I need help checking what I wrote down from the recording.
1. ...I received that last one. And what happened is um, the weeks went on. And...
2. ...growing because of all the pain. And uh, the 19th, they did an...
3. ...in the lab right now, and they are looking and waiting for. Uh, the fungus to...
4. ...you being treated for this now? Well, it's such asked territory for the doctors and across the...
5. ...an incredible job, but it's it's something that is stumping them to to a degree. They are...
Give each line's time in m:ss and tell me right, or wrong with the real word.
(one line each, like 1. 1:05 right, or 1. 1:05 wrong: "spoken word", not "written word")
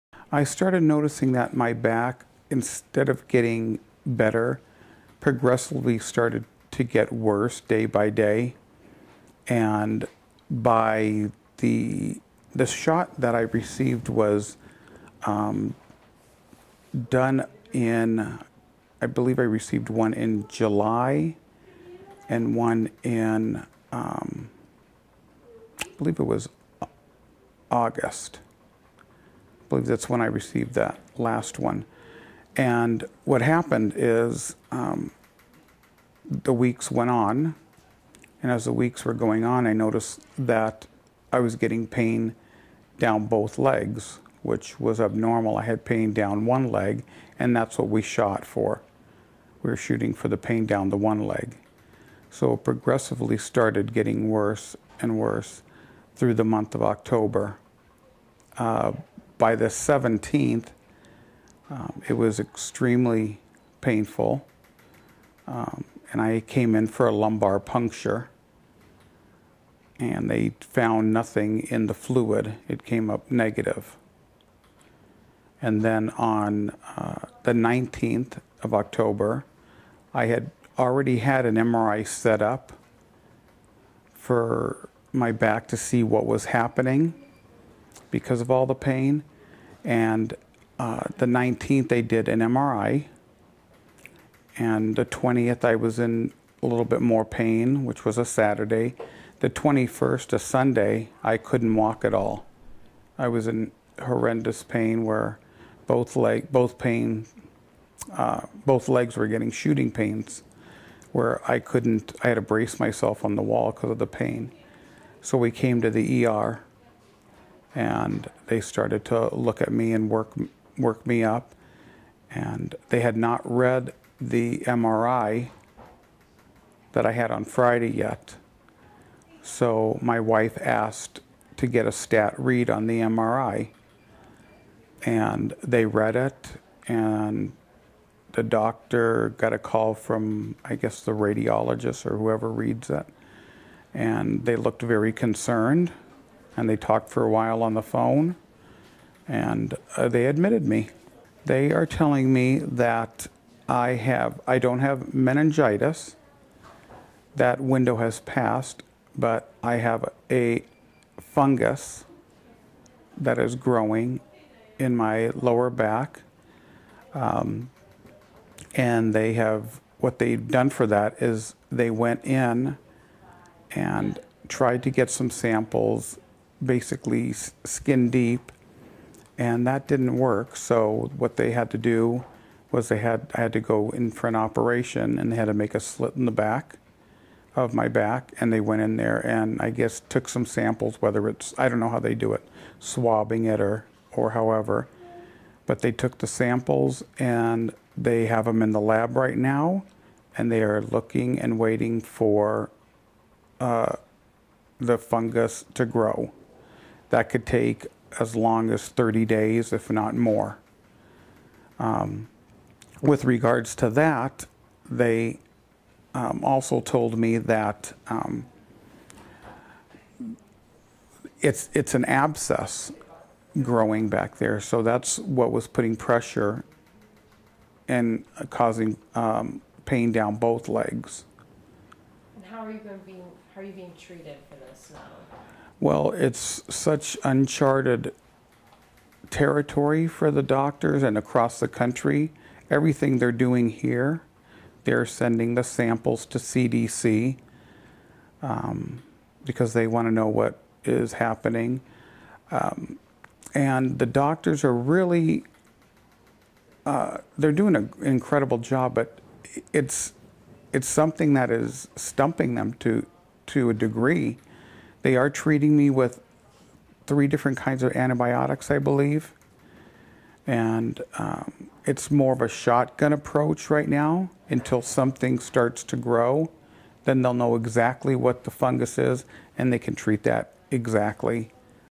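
1. 0:30 right
2. 1:26 wrong: "happening", not "growing"
3. 3:18 right
4. 3:53 wrong: "uncharted", not "asked"
5. 4:17 right.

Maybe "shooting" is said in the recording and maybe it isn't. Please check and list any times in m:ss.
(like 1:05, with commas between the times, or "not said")
0:49, 1:49.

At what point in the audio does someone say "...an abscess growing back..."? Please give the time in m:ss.
3:41.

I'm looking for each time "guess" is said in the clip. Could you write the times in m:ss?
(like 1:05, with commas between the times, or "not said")
2:20, 3:09.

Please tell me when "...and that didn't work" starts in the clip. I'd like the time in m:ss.
2:59.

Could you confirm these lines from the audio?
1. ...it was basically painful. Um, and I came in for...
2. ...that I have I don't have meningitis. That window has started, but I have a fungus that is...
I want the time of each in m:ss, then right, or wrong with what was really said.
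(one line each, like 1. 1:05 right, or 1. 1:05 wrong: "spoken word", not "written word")
1. 1:02 wrong: "extremely", not "basically"
2. 2:32 wrong: "passed", not "started".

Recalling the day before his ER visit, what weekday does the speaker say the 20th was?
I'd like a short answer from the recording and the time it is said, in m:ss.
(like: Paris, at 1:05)
Saturday, at 1:38.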